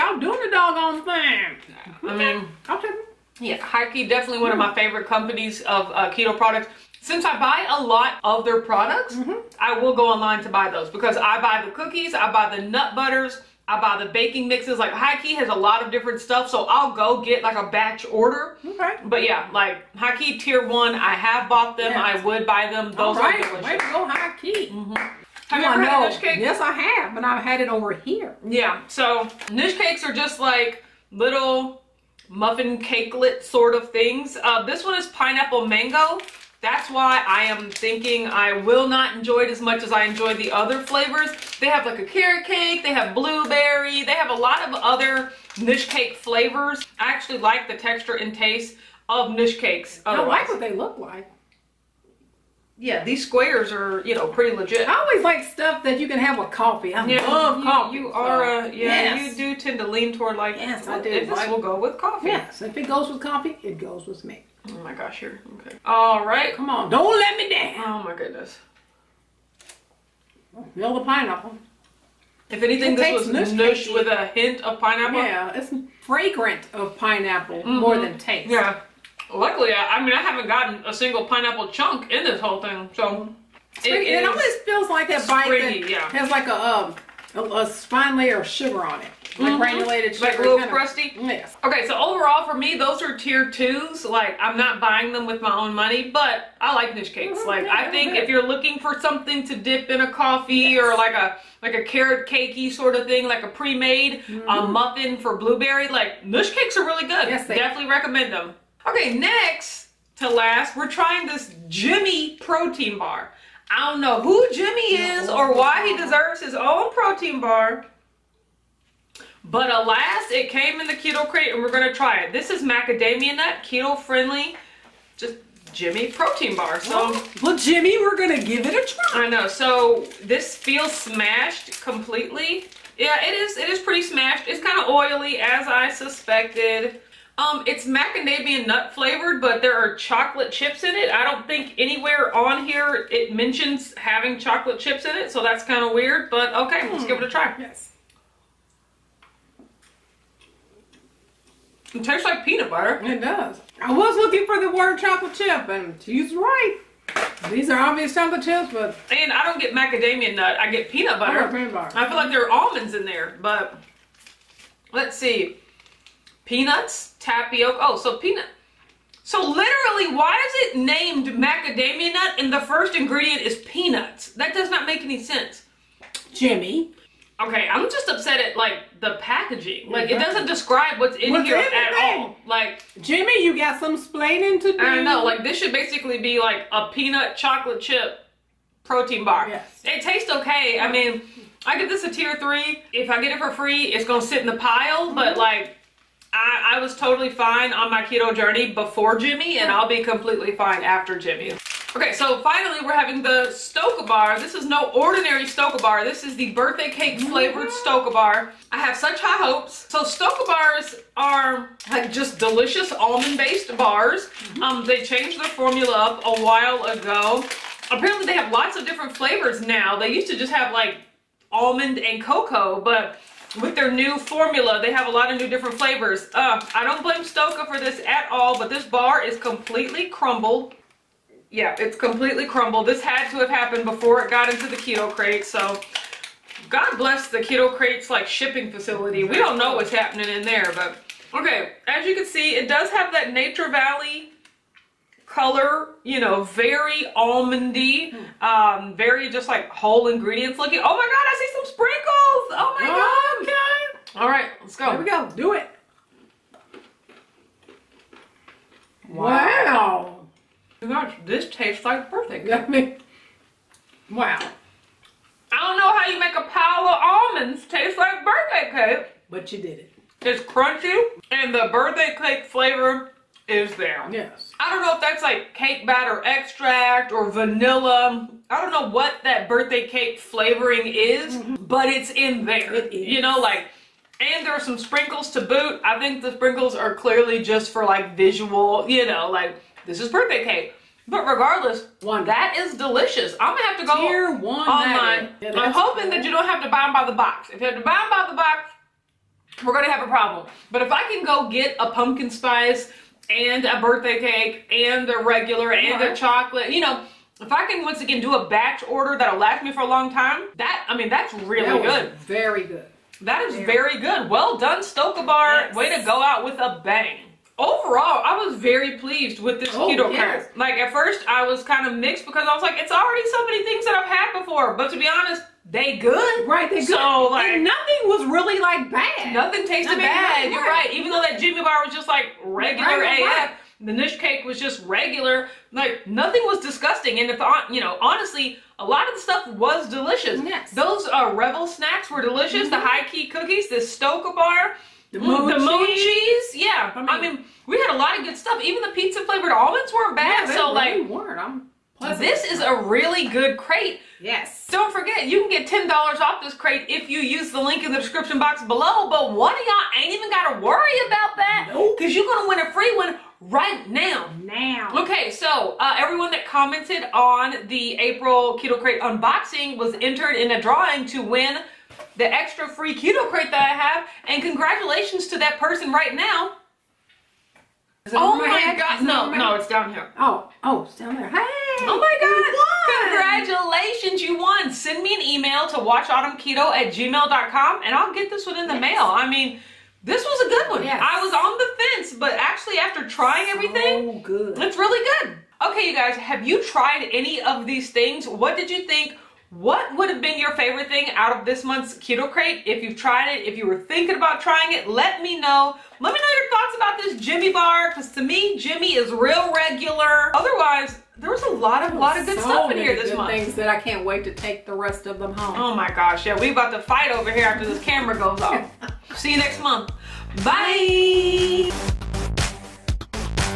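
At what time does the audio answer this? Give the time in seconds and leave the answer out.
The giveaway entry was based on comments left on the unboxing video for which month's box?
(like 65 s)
367 s.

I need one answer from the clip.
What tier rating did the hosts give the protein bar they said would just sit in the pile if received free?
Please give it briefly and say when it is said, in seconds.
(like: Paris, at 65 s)
tier three, at 192 s.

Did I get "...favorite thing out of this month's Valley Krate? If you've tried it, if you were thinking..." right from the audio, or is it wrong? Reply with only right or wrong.
wrong.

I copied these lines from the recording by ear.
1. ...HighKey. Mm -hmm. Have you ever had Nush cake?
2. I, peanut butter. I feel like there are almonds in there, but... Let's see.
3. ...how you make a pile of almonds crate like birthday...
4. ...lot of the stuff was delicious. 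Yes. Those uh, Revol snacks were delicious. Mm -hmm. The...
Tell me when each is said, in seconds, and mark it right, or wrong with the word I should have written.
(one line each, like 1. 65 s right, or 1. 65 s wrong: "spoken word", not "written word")
1. 24 s right
2. 161 s right
3. 265 s wrong: "taste", not "crate"
4. 338 s right.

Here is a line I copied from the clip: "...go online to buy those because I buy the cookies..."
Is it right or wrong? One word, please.
right.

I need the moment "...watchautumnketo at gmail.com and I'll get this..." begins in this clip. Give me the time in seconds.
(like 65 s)
385 s.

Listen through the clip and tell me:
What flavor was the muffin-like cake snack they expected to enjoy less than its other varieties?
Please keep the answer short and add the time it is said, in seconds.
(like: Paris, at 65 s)
pineapple mango, at 35 s.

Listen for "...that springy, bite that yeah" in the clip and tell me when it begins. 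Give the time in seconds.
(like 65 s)
85 s.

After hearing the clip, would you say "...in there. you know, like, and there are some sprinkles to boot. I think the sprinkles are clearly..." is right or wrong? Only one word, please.
right.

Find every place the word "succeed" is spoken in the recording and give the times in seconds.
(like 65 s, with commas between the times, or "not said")
not said.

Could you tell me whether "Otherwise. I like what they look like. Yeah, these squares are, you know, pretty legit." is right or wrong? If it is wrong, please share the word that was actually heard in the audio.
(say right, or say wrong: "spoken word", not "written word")
right.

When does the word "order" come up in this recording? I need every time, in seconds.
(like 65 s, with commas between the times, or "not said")
18 s, 308 s.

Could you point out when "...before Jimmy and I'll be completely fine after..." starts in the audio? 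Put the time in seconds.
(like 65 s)
198 s.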